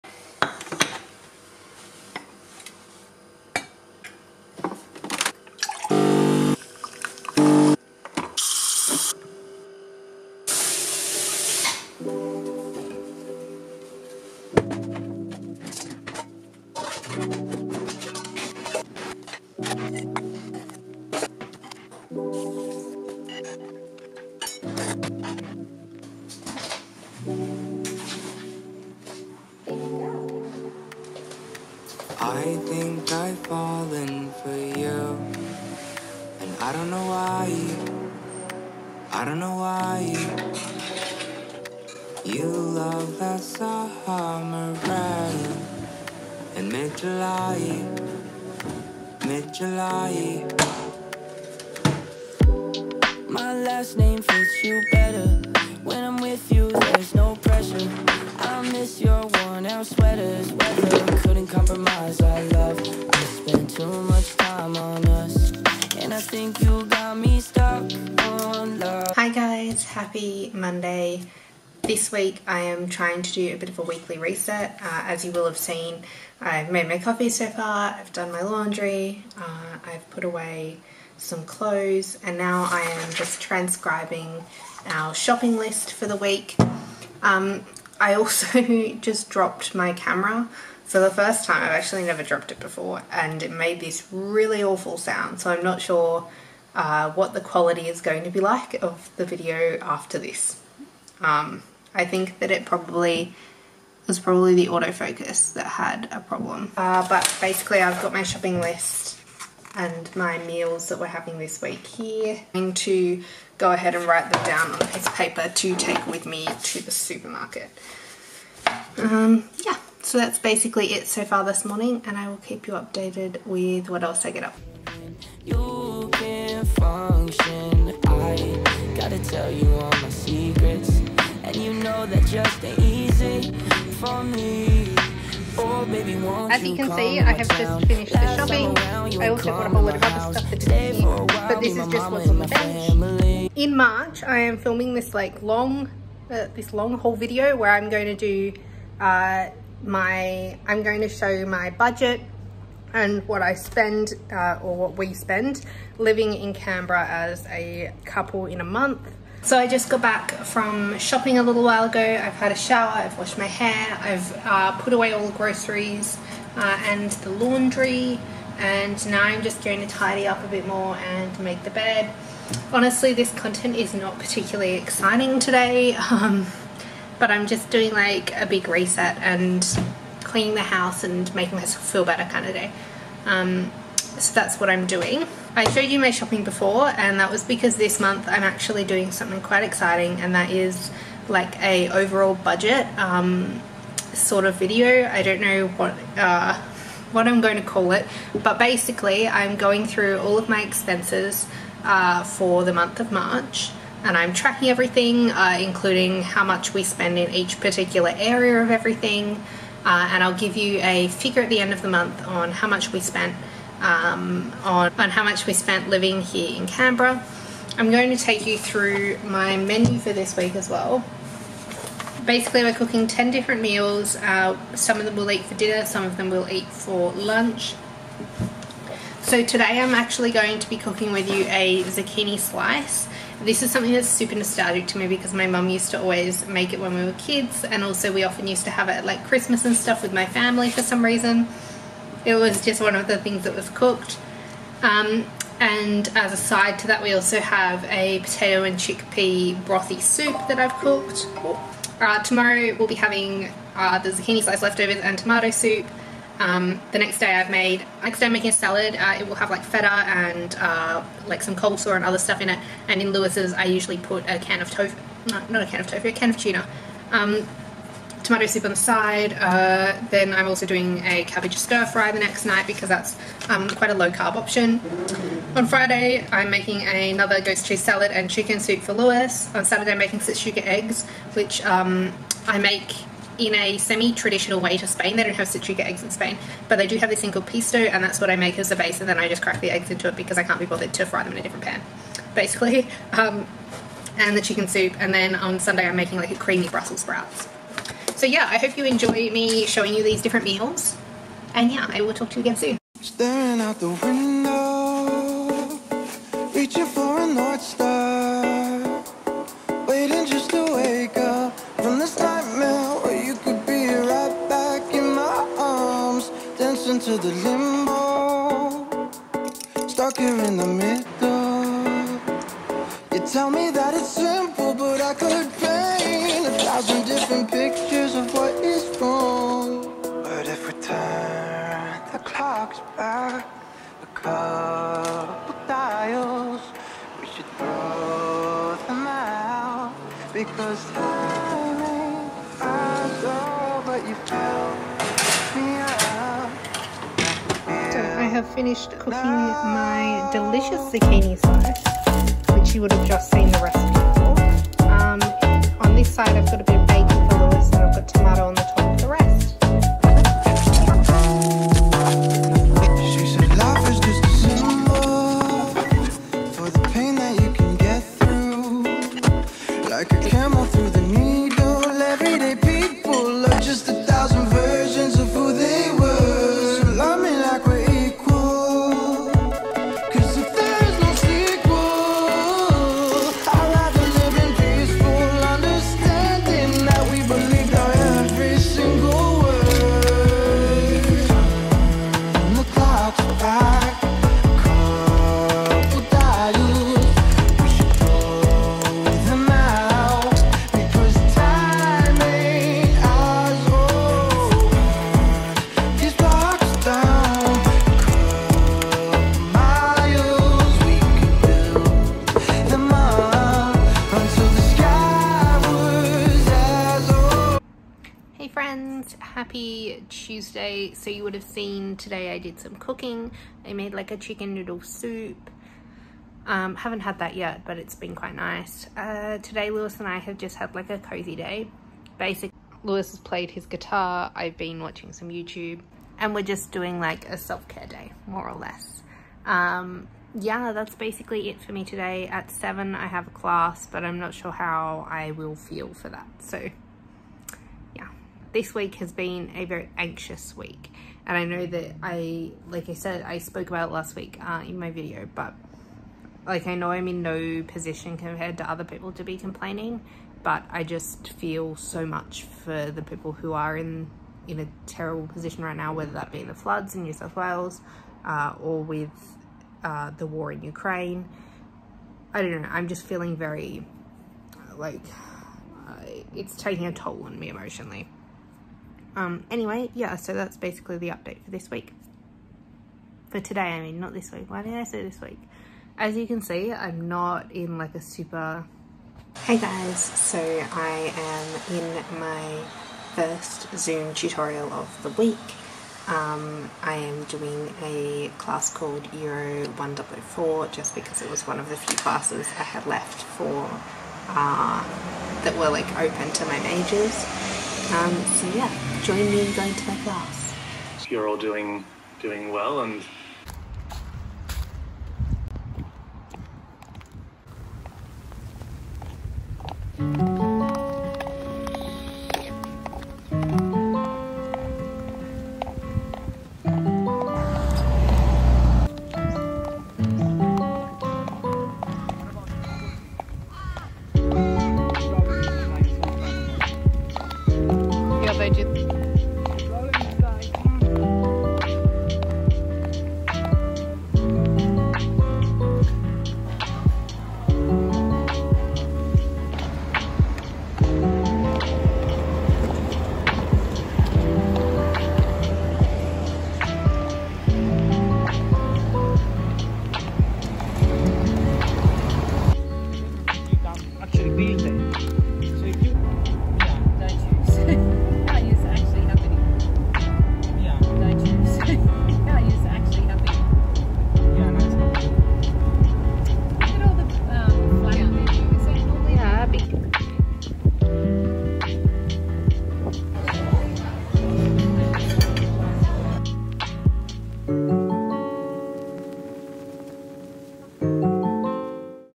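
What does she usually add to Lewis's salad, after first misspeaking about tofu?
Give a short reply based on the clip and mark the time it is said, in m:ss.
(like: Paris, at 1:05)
a can of tuna, at 4:26.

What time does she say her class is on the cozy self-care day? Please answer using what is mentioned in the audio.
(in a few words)
7.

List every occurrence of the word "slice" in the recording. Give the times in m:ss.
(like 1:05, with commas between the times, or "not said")
3:52, 4:14.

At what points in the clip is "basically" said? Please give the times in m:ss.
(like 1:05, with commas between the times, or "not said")
1:47, 2:00, 3:18, 3:42, 4:52, 7:12, 7:20, 8:00.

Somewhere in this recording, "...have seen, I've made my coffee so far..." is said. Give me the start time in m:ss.
1:15.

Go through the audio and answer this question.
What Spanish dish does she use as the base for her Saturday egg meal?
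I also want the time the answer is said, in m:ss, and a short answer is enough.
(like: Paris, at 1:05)
pisto, at 4:47.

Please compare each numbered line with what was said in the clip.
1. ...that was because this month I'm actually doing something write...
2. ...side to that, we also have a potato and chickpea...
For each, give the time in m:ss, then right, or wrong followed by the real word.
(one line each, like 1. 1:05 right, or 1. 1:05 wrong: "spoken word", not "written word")
1. 3:07 wrong: "quite", not "write"
2. 4:06 right.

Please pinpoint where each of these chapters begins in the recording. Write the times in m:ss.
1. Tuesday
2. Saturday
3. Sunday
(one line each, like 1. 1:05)
1. 6:18
2. 8:34
3. 9:26.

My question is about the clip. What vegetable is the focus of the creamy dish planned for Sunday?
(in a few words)
Brussels sprouts.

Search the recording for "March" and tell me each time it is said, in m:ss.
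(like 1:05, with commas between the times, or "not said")
2:23, 3:23.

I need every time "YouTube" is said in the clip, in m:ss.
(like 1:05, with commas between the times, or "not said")
7:15.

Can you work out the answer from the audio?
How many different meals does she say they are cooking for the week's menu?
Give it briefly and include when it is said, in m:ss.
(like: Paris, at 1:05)
10, at 3:43.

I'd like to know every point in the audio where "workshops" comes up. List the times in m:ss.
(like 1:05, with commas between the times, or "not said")
not said.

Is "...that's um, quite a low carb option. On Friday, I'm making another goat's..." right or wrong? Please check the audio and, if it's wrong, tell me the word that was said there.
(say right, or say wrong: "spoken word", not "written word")
right.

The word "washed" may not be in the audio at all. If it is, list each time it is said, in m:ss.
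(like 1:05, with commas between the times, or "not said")
2:43.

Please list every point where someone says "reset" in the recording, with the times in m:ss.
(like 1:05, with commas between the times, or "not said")
1:14, 2:58.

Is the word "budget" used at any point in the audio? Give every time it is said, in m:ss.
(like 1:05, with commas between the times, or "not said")
2:31, 3:12.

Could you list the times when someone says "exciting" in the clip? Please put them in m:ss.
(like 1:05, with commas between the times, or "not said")
2:54, 3:09.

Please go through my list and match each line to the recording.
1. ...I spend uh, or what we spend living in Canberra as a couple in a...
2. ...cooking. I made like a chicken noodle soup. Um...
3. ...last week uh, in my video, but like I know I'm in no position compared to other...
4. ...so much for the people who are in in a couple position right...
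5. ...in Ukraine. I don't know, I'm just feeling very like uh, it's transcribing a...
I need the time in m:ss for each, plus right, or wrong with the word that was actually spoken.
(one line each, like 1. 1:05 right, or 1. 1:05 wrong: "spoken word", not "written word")
1. 2:33 right
2. 7:02 right
3. 7:33 right
4. 7:41 wrong: "terrible", not "couple"
5. 7:50 wrong: "taking", not "transcribing".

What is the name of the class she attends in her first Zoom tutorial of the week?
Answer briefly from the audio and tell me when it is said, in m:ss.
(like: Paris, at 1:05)
Euro 104, at 8:19.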